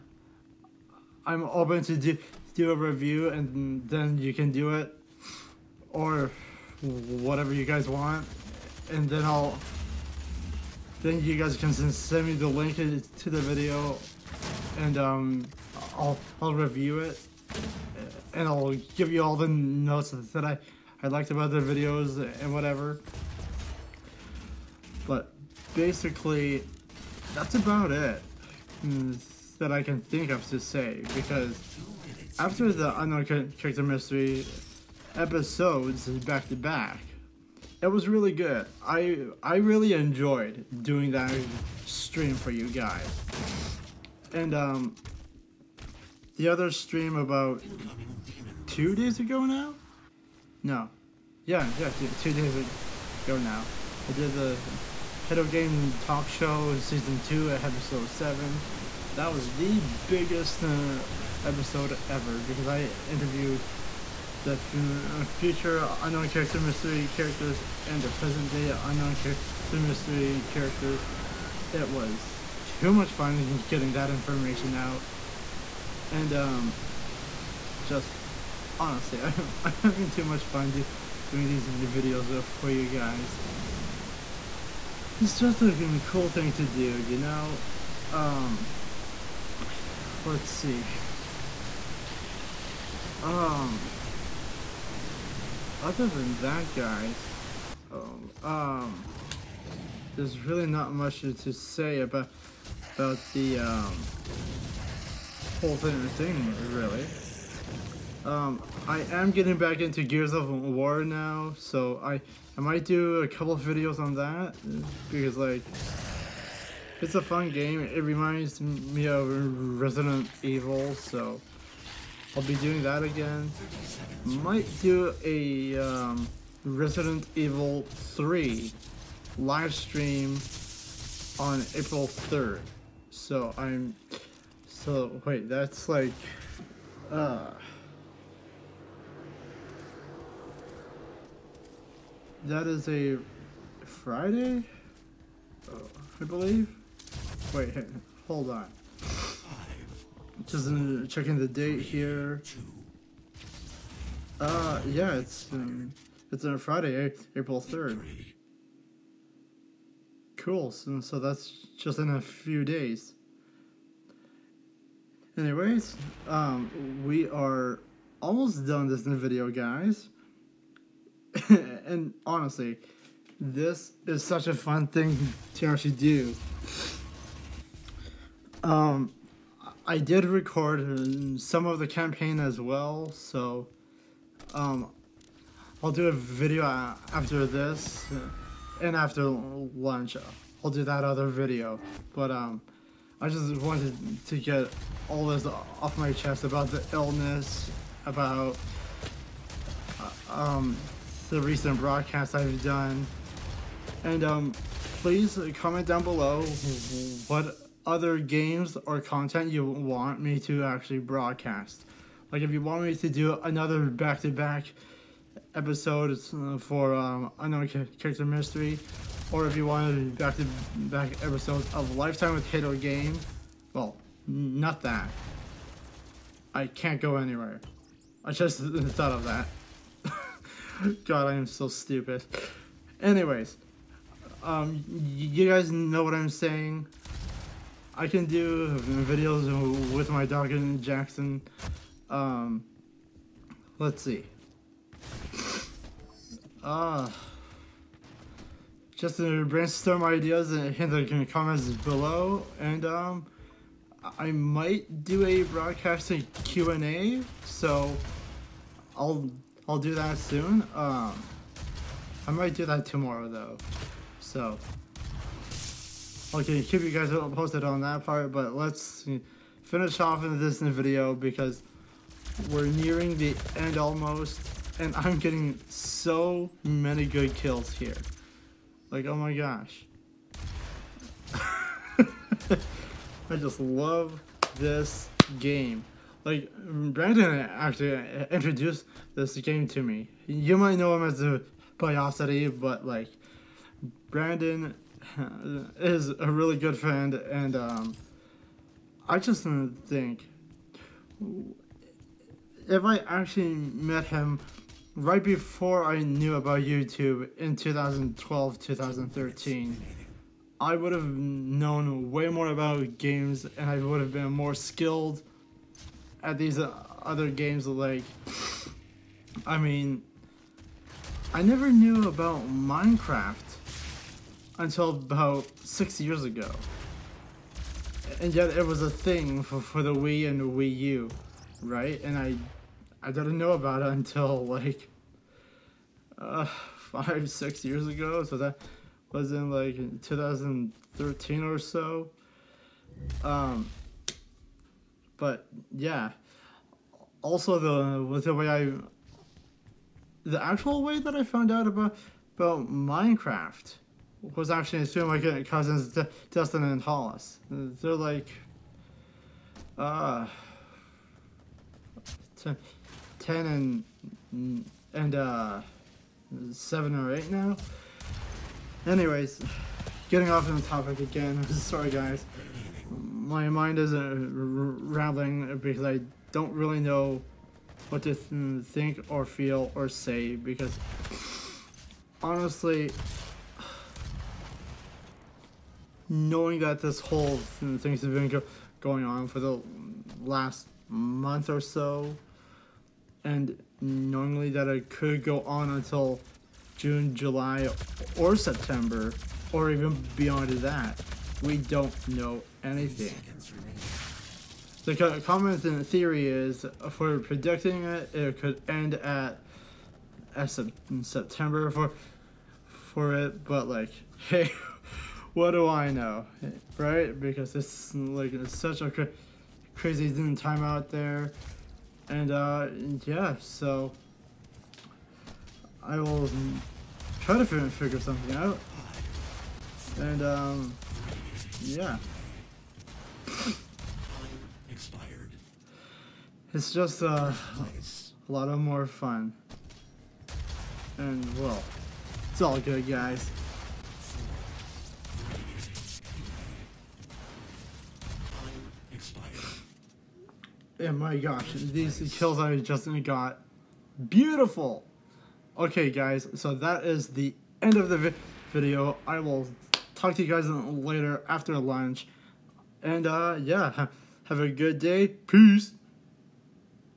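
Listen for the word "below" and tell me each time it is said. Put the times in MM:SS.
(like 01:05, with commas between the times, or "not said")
03:26, 04:11.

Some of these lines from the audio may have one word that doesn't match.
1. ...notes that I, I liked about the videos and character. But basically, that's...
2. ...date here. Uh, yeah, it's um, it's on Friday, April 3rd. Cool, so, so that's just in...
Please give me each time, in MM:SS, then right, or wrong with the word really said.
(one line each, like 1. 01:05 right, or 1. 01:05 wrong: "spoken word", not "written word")
1. 00:19 wrong: "whatever", not "character"
2. 02:31 right.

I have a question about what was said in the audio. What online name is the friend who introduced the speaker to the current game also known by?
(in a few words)
Biosity.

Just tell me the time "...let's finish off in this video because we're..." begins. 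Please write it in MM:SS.
04:28.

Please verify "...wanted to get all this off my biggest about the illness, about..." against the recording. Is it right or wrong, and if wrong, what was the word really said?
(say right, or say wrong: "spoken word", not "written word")
wrong: "chest", not "biggest".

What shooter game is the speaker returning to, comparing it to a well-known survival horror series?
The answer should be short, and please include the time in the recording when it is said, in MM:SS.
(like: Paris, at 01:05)
Gears of War, at 01:50.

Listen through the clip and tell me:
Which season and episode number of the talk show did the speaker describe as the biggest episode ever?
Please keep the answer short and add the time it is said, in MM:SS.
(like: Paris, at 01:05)
Season 2 Episode 7, at 00:56.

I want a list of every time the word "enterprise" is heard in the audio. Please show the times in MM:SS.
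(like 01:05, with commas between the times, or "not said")
not said.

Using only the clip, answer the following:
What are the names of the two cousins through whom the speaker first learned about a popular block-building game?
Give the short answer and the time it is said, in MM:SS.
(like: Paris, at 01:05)
De and Hollis, at 05:55.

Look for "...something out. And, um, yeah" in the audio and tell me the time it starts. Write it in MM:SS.
07:08.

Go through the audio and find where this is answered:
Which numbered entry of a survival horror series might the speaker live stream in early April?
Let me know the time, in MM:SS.
02:06.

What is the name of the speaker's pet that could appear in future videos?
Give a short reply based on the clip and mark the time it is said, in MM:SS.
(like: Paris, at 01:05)
Jackson, at 04:00.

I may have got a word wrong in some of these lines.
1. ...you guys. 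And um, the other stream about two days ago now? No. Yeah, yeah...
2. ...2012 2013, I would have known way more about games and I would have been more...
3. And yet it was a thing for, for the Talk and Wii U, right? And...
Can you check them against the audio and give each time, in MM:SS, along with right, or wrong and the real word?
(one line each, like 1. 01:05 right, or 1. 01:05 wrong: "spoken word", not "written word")
1. 00:42 right
2. 05:07 right
3. 05:28 wrong: "Wii", not "Talk".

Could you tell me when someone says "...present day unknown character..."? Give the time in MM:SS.
01:08.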